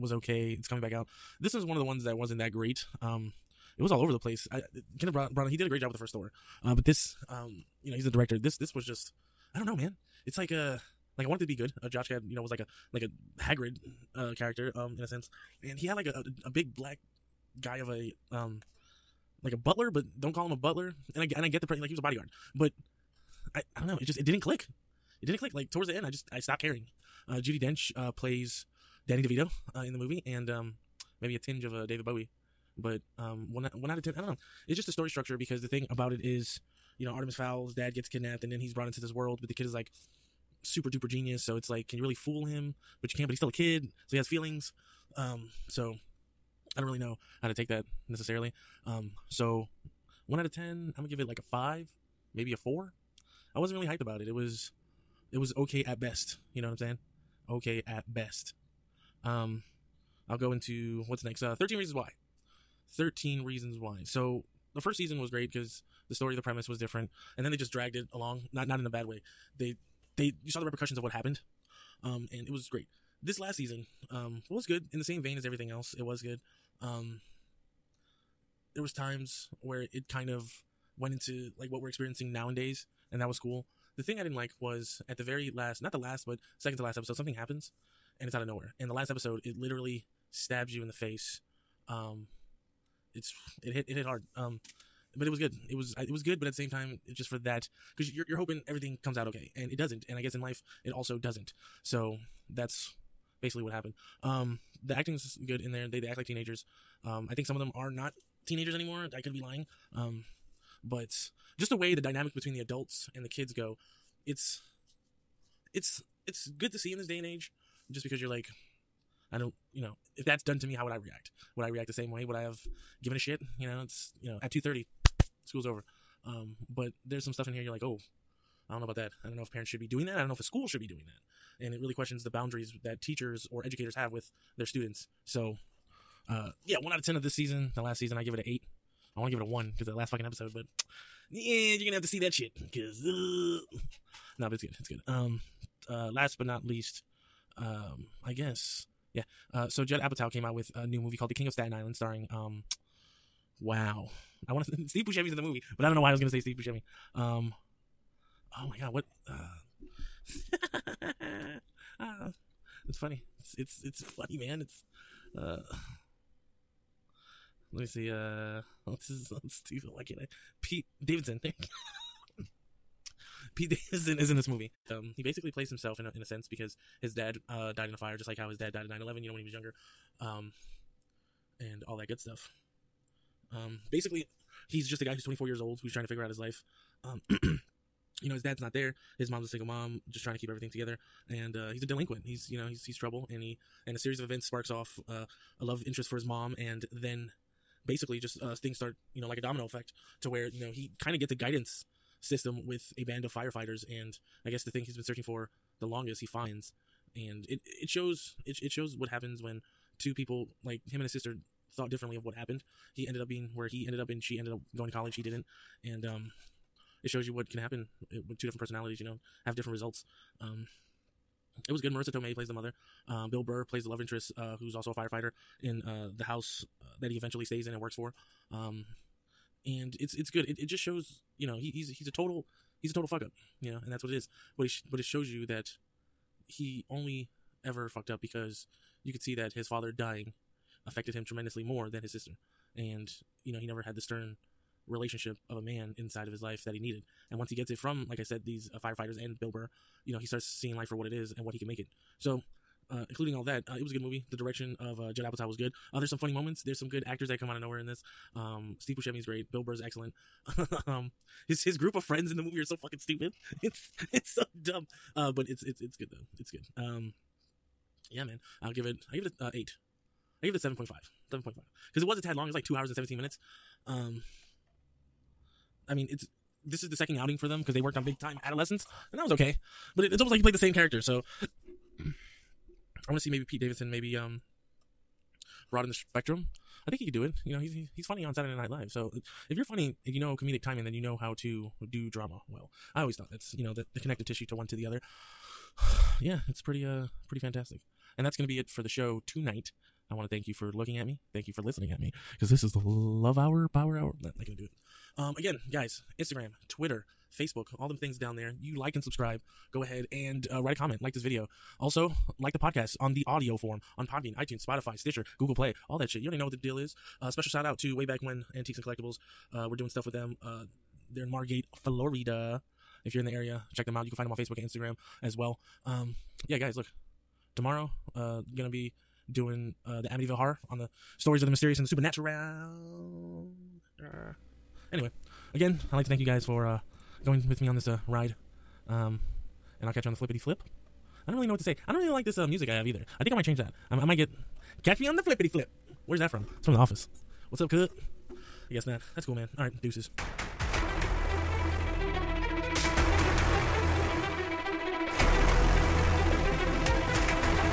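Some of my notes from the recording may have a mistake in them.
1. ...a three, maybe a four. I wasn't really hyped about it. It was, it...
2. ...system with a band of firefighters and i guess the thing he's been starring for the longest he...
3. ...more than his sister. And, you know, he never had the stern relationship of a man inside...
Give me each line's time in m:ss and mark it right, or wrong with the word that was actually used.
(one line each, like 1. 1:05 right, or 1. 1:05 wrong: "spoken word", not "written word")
1. 0:51 wrong: "five", not "three"
2. 3:22 wrong: "searching", not "starring"
3. 4:01 right.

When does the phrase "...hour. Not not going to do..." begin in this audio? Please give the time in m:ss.
5:03.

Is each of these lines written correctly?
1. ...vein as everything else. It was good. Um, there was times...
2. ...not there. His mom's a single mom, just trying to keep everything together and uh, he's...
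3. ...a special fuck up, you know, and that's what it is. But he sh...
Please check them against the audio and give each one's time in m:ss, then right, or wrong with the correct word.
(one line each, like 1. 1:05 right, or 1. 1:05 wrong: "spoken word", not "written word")
1. 1:15 right
2. 3:08 right
3. 3:52 wrong: "total", not "special".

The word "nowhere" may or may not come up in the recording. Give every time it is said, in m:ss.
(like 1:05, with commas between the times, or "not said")
1:28, 4:17.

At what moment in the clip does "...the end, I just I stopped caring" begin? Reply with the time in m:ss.
0:25.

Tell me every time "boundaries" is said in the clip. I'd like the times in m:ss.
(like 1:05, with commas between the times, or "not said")
2:12.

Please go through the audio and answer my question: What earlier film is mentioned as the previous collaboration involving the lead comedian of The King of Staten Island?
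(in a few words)
Big Time Adolescence.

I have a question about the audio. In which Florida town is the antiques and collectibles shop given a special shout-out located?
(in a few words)
Margate.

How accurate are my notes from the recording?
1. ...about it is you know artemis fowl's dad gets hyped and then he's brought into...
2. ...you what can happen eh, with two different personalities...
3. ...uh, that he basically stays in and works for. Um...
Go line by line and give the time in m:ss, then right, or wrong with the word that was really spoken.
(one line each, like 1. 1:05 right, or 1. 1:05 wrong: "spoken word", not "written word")
1. 0:35 wrong: "kidnapped", not "hyped"
2. 3:37 right
3. 3:46 wrong: "eventually", not "basically".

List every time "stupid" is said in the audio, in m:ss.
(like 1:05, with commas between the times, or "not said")
2:49, 4:22.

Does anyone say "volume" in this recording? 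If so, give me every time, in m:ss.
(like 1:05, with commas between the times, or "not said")
not said.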